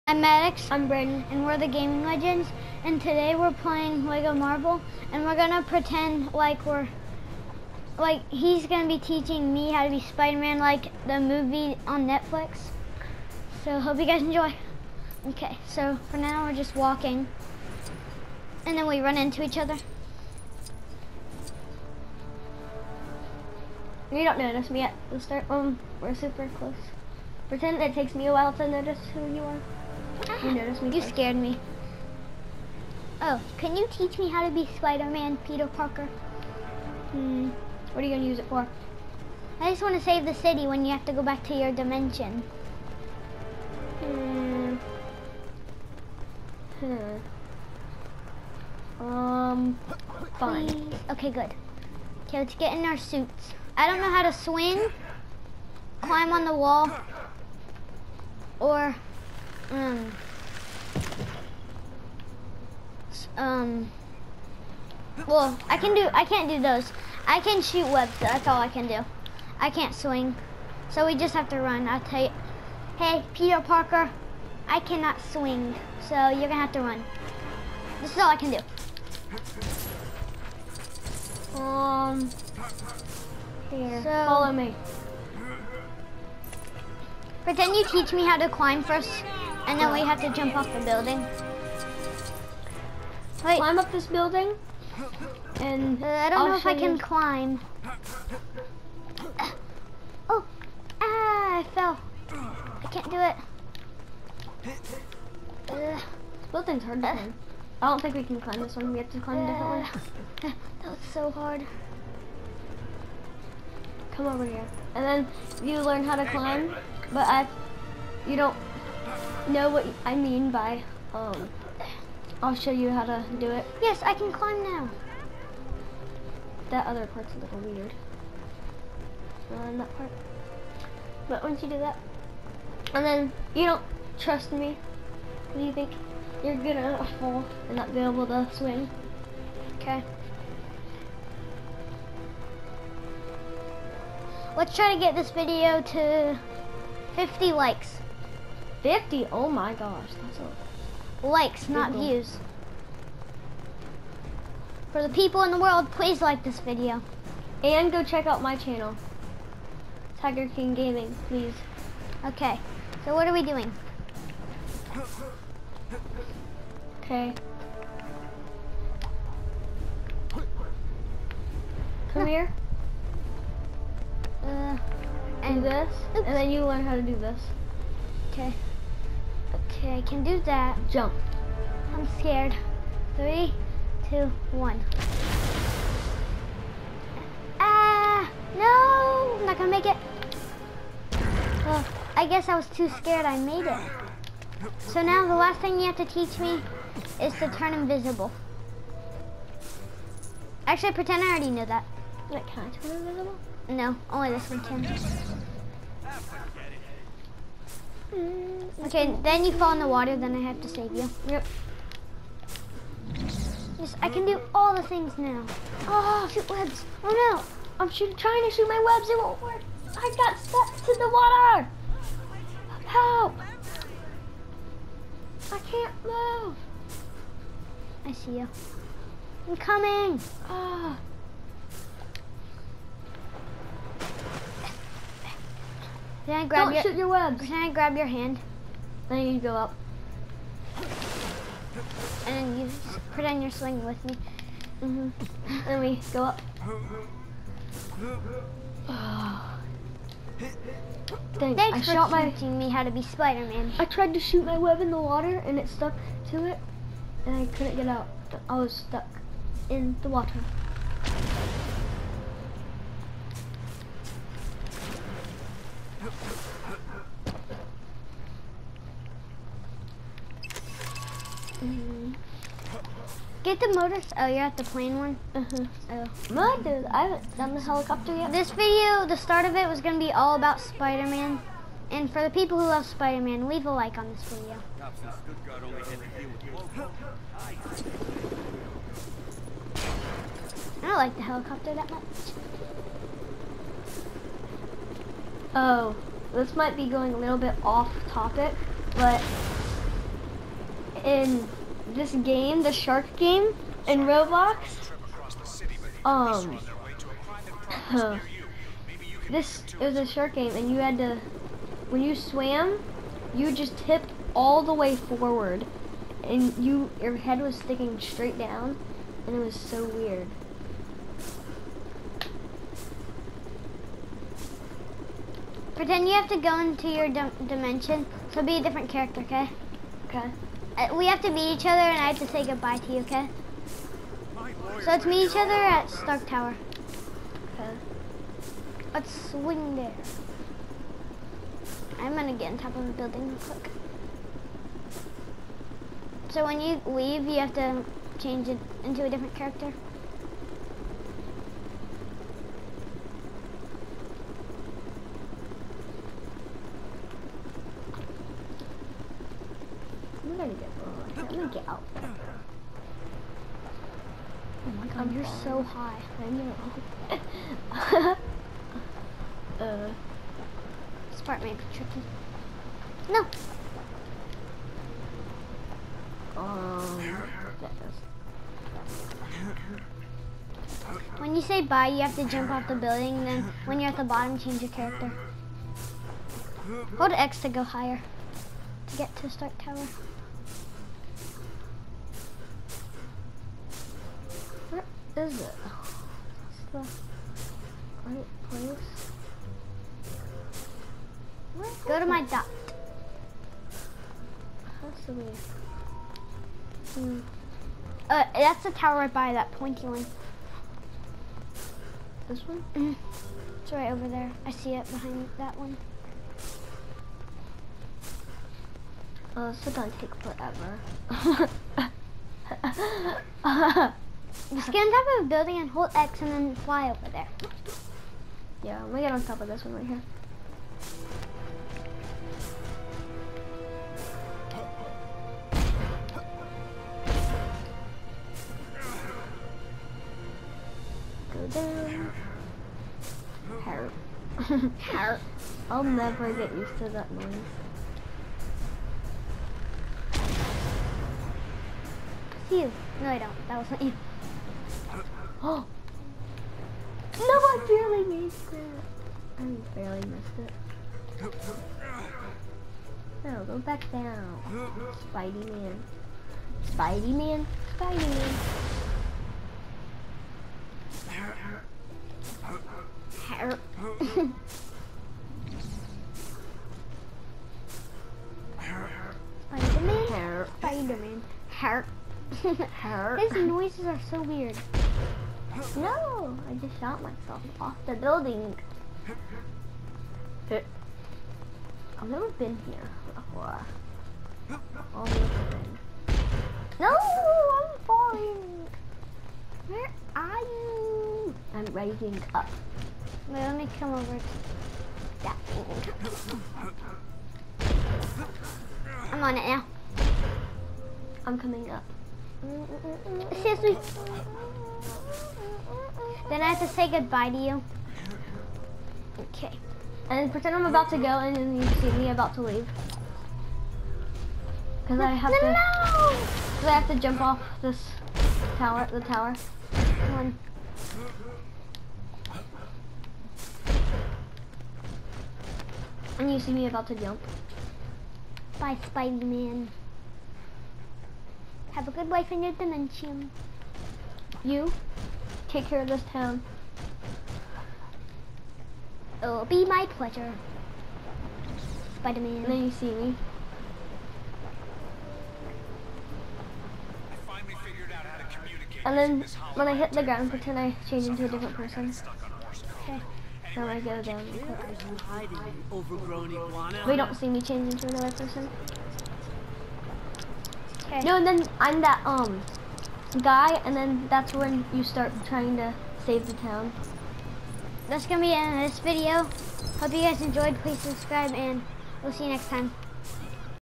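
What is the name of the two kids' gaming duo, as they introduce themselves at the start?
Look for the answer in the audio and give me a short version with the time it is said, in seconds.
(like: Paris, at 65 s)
Gaming Legends, at 1 s.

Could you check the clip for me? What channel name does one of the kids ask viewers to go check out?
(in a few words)
Tiger King Gaming.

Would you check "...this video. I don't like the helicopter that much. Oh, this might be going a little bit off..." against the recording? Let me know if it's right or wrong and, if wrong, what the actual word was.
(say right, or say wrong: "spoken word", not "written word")
right.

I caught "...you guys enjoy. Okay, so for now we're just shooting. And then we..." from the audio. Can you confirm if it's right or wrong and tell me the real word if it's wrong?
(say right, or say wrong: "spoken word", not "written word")
wrong: "walking", not "shooting".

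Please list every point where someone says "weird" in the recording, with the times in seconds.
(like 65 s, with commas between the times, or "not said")
127 s, 319 s, 484 s.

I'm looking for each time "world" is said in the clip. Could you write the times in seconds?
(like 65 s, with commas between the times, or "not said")
155 s.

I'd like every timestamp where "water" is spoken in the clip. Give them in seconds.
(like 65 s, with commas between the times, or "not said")
209 s, 221 s, 255 s, 260 s.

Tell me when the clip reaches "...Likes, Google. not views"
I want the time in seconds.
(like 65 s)
151 s.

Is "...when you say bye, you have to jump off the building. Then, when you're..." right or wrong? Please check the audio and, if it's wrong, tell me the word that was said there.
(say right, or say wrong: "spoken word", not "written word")
right.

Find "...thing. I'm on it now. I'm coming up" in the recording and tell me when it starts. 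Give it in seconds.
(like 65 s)
505 s.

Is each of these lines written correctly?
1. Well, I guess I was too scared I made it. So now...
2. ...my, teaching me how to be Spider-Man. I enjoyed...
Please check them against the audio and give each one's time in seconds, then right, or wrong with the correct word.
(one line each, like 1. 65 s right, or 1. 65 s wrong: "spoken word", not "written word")
1. 191 s right
2. 252 s wrong: "tried", not "enjoyed".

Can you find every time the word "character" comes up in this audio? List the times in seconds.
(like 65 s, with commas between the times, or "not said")
328 s, 349 s, 384 s.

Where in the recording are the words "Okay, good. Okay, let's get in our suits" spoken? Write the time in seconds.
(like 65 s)
51 s.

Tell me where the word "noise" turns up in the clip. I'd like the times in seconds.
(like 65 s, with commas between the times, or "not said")
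447 s, 483 s.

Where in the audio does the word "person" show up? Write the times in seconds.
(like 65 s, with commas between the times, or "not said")
561 s, 568 s.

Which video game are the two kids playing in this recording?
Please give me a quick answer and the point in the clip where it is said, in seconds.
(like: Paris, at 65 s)
Lego Marvel, at 4 s.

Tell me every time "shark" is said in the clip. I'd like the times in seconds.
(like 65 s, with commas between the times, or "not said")
302 s, 310 s.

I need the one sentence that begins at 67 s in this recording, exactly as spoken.
I can shoot webs, that's all I can do.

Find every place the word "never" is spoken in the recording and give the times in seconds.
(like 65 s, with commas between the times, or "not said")
445 s, 492 s.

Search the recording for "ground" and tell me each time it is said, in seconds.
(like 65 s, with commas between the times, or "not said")
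560 s.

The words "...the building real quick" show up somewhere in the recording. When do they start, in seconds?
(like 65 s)
342 s.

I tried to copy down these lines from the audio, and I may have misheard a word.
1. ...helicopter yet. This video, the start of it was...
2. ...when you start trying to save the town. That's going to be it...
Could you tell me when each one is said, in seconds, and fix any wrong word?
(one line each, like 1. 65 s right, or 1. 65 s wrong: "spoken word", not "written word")
1. 277 s right
2. 574 s right.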